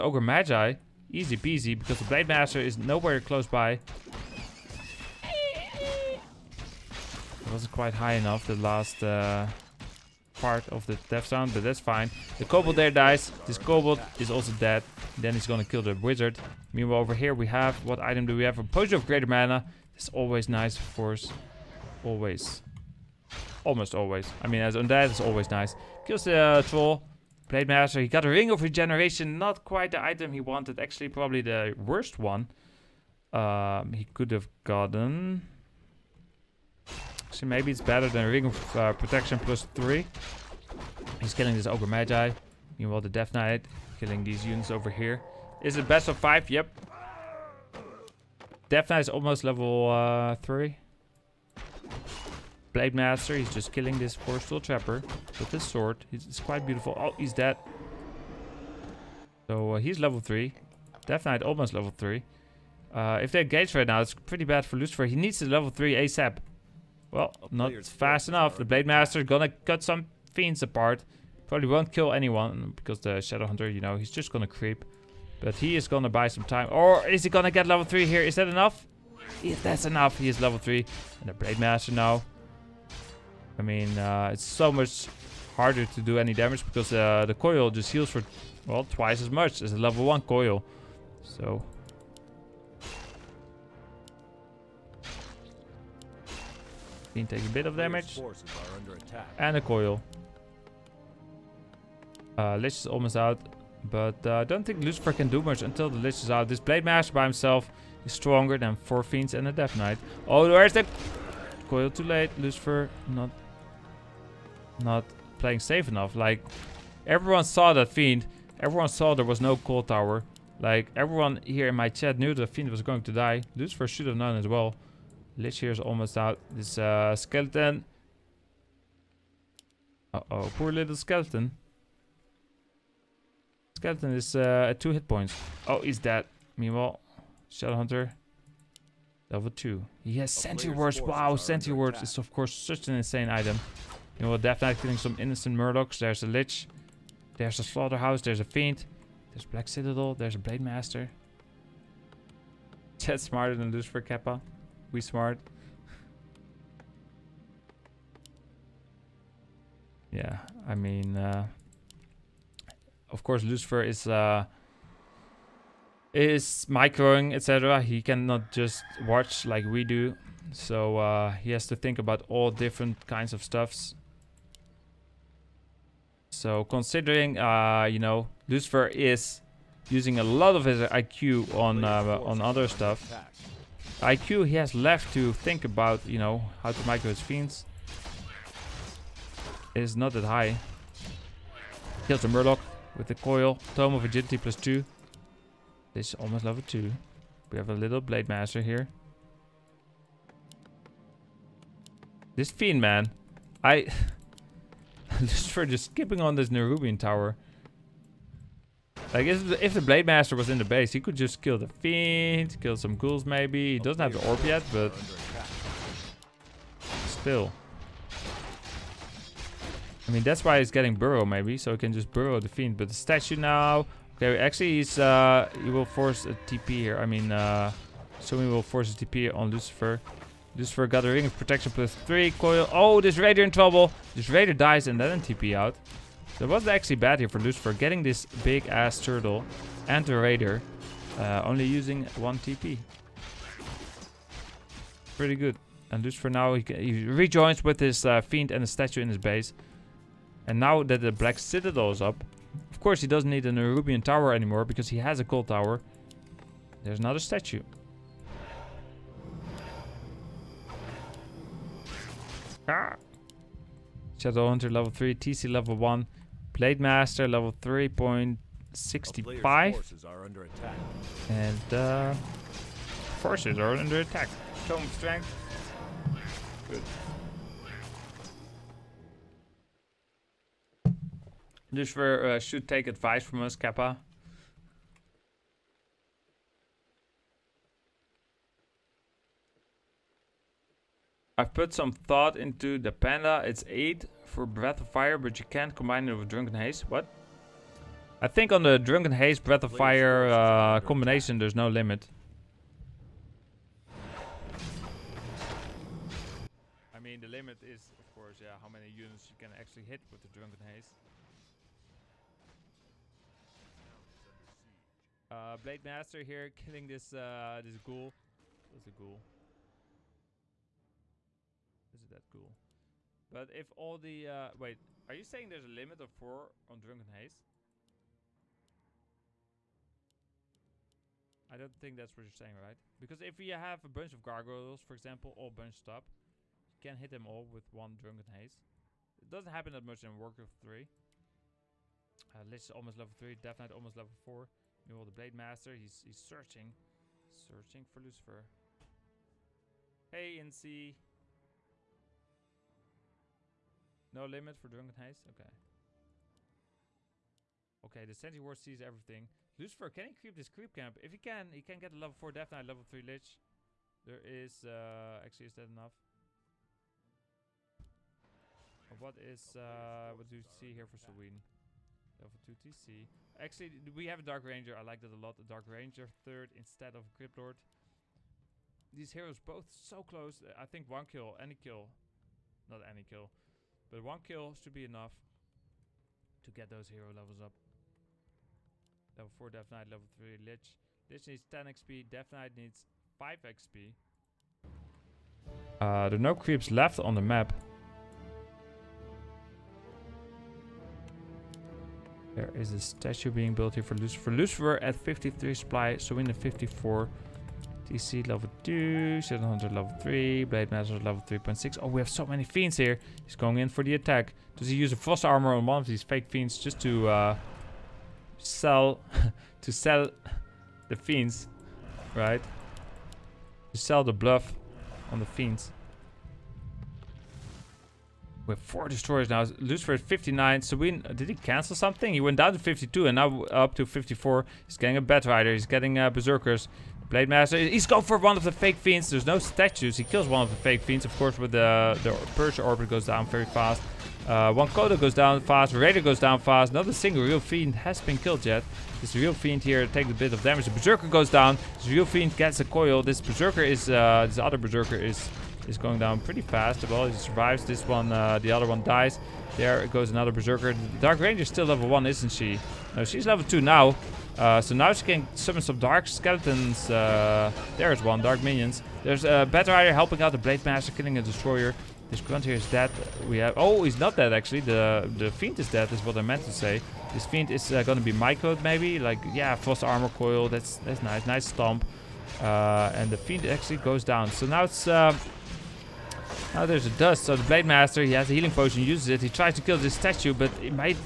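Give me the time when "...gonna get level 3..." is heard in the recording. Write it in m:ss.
1:17.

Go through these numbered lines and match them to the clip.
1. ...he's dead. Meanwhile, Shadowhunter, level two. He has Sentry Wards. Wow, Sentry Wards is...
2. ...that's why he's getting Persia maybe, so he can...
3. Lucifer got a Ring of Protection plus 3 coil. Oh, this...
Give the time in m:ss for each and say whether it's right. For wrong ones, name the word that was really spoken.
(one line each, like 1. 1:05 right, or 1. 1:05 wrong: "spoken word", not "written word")
1. 2:15 right
2. 3:40 wrong: "Burrow", not "Persia"
3. 3:50 right.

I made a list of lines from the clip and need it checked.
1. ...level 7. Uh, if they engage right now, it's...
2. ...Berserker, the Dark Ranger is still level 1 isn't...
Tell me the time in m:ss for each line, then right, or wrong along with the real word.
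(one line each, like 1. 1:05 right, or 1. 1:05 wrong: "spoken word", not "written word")
1. 1:01 wrong: "3", not "7"
2. 7:40 right.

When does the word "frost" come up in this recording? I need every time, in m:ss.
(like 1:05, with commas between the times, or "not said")
6:54, 7:59.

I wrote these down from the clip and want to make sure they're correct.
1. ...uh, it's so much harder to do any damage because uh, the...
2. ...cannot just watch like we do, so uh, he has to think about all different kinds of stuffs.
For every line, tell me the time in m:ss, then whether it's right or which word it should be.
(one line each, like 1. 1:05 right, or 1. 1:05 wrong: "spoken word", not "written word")
1. 1:23 right
2. 2:48 right.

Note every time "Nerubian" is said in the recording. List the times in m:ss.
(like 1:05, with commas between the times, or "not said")
3:26, 4:13.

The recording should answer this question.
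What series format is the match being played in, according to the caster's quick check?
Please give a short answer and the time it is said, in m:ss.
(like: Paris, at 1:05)
Best of 5, at 0:45.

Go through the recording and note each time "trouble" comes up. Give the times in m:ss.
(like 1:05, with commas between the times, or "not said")
3:53.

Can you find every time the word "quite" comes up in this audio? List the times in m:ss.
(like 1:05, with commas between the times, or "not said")
0:07, 0:29, 0:56.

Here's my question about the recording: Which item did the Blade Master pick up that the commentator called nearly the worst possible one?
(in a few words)
Ring of Regeneration.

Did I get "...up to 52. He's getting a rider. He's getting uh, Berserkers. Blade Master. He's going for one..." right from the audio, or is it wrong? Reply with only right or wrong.
wrong.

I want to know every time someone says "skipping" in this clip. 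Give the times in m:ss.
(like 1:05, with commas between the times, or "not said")
3:25.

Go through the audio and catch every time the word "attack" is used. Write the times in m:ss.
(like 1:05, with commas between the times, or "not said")
4:34, 6:53.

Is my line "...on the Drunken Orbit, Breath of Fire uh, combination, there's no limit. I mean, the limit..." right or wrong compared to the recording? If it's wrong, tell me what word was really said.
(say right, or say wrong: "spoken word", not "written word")
wrong: "Haze", not "Orbit".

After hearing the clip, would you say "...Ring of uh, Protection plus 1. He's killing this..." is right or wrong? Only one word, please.
wrong.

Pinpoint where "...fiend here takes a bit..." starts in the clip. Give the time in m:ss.
7:29.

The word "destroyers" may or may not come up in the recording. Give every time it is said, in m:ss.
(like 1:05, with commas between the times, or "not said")
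7:08, 7:51.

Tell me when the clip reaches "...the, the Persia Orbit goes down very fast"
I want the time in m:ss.
7:21.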